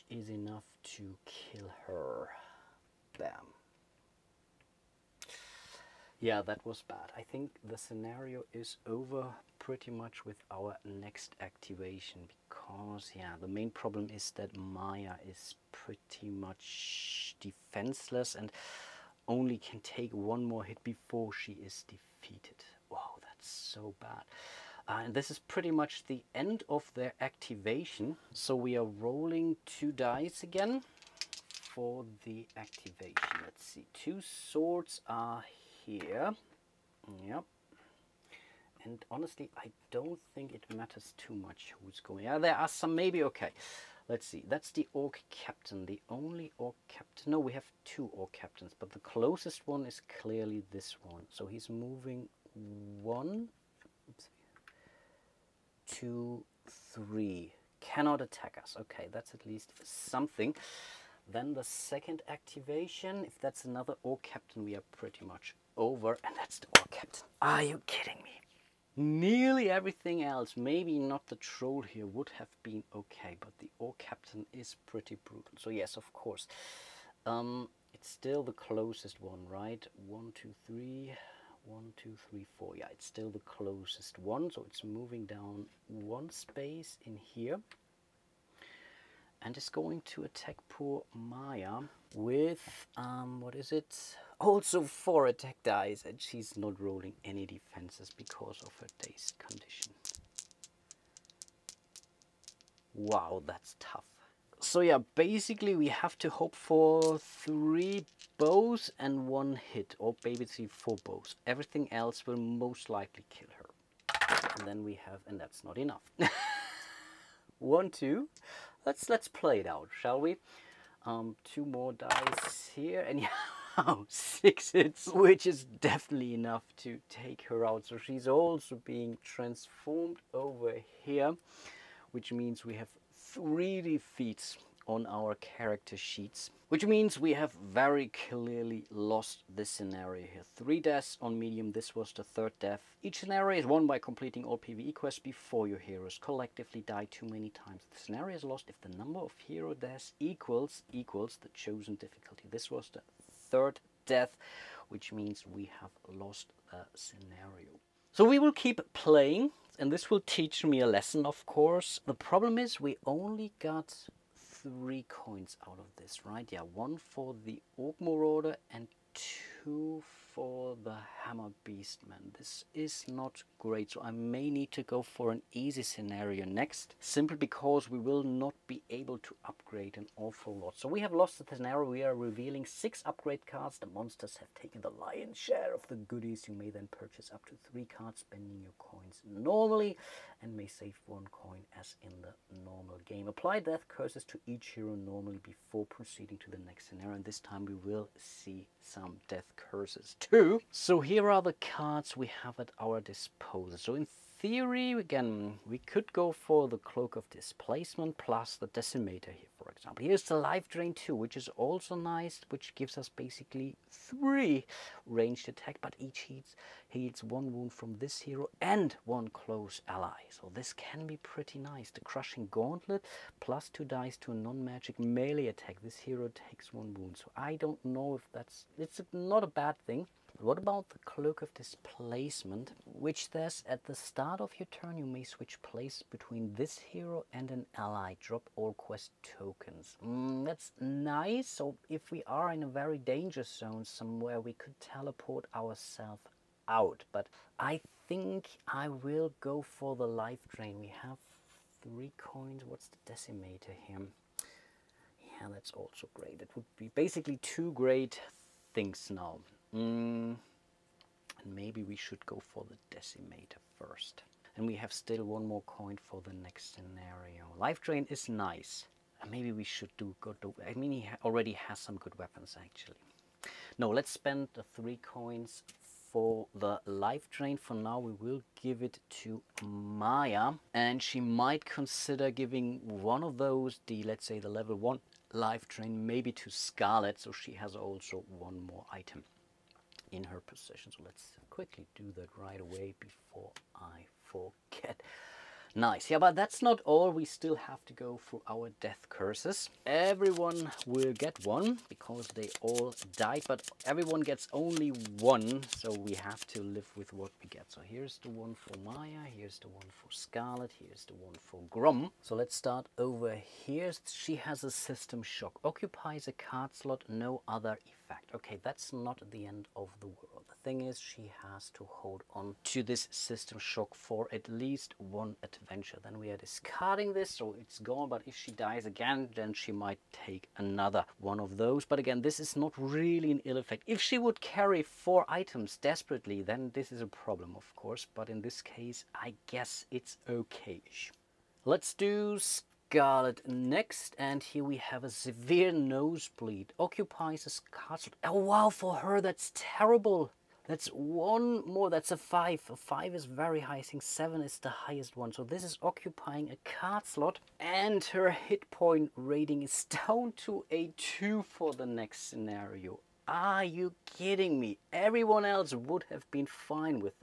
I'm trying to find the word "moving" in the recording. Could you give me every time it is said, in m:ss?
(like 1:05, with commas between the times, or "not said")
0:51, 1:24.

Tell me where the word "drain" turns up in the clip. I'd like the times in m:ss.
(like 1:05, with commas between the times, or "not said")
3:30, 4:10, 4:27, 4:37, 4:45.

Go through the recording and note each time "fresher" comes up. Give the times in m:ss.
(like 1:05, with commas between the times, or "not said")
not said.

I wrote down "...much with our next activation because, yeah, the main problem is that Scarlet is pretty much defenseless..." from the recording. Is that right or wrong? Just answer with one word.
wrong.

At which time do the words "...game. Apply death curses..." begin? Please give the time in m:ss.
3:13.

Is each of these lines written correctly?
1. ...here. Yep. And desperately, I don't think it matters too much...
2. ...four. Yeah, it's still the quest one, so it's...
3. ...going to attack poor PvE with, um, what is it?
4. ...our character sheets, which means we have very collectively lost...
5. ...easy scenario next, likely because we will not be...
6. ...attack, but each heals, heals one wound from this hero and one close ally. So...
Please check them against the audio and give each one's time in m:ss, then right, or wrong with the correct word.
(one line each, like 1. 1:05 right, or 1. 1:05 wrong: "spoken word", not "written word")
1. 0:35 wrong: "honestly", not "desperately"
2. 1:22 wrong: "closest", not "quest"
3. 1:29 wrong: "Maya", not "PvE"
4. 2:15 wrong: "clearly", not "collectively"
5. 2:55 wrong: "simply", not "likely"
6. 3:35 right.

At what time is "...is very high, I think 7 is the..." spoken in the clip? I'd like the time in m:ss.
5:53.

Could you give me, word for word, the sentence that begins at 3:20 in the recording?
So here are the cards we have at our disposal.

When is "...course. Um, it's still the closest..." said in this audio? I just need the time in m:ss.
1:16.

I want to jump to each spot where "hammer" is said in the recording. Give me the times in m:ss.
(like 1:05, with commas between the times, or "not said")
2:51.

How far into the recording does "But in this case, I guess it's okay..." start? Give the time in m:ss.
5:38.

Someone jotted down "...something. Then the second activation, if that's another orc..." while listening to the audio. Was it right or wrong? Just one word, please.
right.